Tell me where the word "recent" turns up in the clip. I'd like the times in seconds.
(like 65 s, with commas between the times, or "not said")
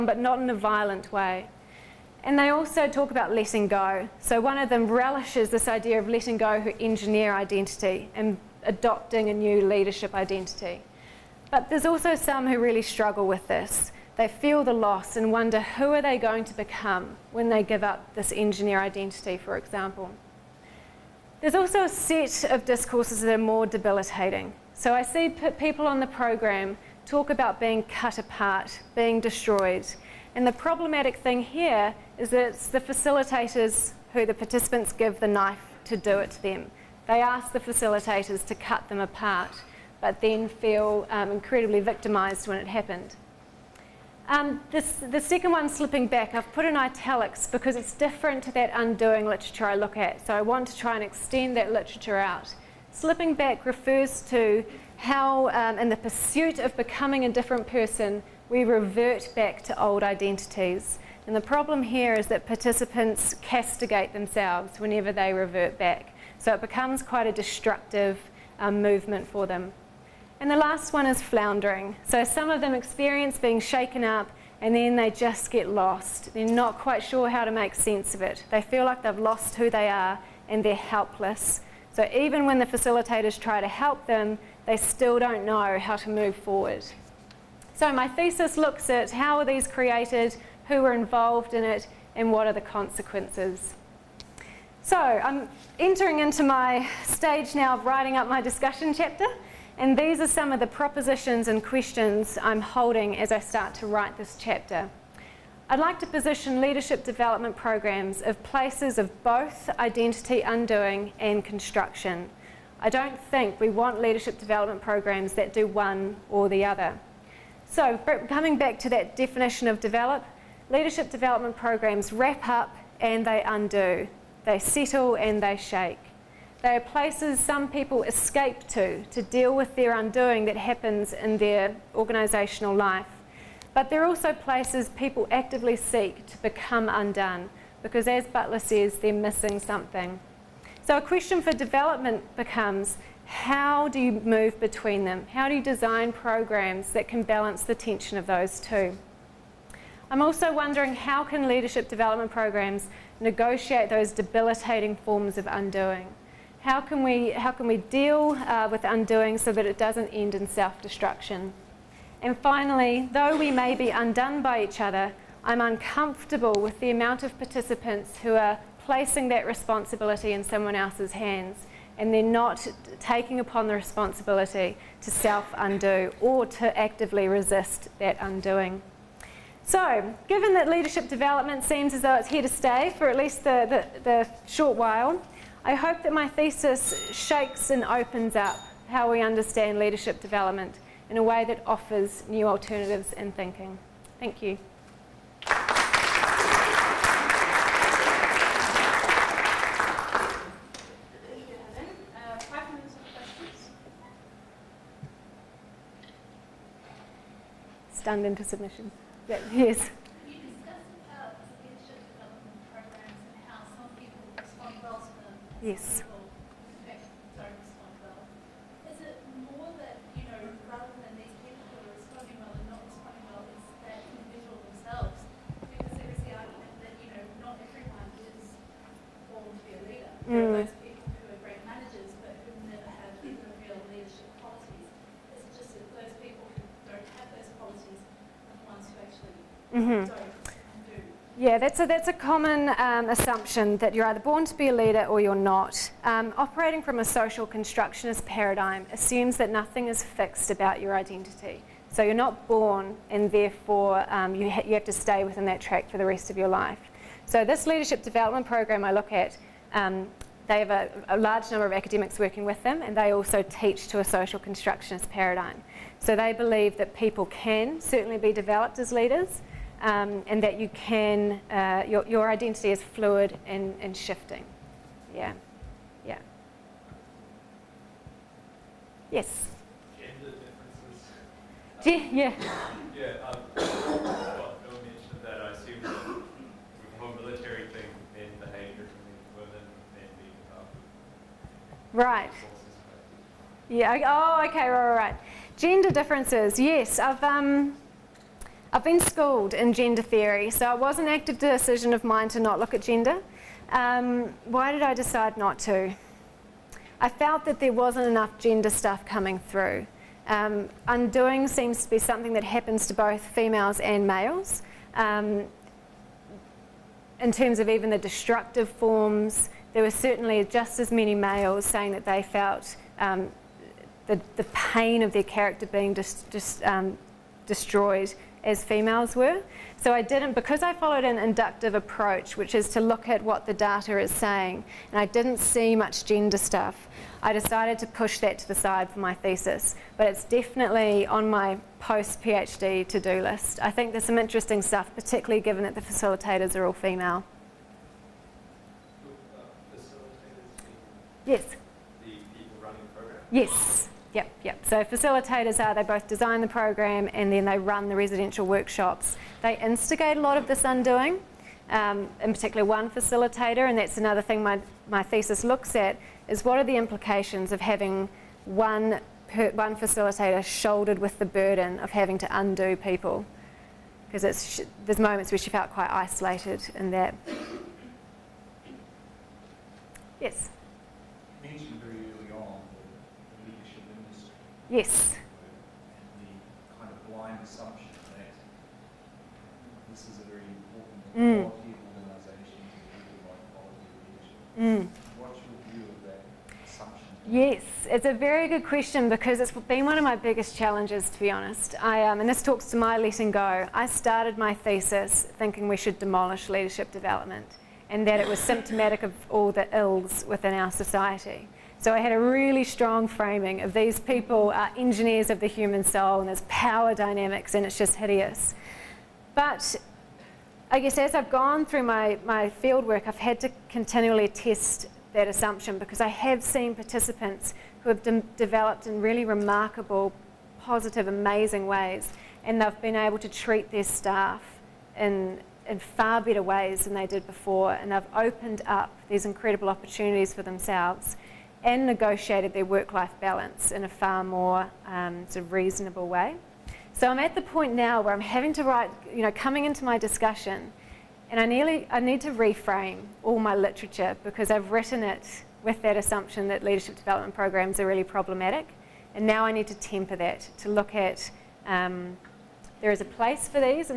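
not said.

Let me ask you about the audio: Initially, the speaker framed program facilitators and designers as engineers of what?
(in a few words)
The human soul.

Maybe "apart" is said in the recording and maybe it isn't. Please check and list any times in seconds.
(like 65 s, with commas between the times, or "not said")
28 s, 39 s.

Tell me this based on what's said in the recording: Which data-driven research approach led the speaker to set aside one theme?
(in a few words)
Inductive approach.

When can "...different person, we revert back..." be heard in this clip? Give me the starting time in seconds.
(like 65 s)
57 s.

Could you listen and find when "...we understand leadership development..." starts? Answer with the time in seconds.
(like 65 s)
189 s.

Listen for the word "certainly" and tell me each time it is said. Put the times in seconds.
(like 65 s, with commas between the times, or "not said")
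267 s, 319 s.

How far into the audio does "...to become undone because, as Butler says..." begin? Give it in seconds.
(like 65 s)
136 s.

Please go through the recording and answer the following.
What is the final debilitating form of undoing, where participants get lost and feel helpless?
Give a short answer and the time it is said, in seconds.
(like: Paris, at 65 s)
Floundering, at 71 s.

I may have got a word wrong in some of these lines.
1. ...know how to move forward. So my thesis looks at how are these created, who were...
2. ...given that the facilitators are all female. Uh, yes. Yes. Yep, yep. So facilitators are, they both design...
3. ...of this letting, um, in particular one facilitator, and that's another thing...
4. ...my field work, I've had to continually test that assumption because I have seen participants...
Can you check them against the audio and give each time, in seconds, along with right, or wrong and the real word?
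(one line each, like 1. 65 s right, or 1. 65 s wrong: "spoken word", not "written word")
1. 85 s right
2. 345 s right
3. 360 s wrong: "undoing", not "letting"
4. 422 s right.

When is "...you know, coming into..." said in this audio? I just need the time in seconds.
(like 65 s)
449 s.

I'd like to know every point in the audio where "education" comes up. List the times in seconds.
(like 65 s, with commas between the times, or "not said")
not said.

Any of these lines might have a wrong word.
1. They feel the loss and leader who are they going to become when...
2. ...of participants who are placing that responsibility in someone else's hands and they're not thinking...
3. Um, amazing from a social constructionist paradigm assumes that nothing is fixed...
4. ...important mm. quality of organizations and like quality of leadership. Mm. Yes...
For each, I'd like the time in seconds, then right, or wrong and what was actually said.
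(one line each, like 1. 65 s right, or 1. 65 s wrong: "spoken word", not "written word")
1. 14 s wrong: "wonder", not "leader"
2. 167 s wrong: "taking", not "thinking"
3. 246 s wrong: "operating", not "amazing"
4. 390 s right.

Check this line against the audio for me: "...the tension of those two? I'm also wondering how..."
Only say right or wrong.
right.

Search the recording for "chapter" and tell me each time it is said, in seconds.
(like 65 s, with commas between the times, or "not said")
98 s, 104 s.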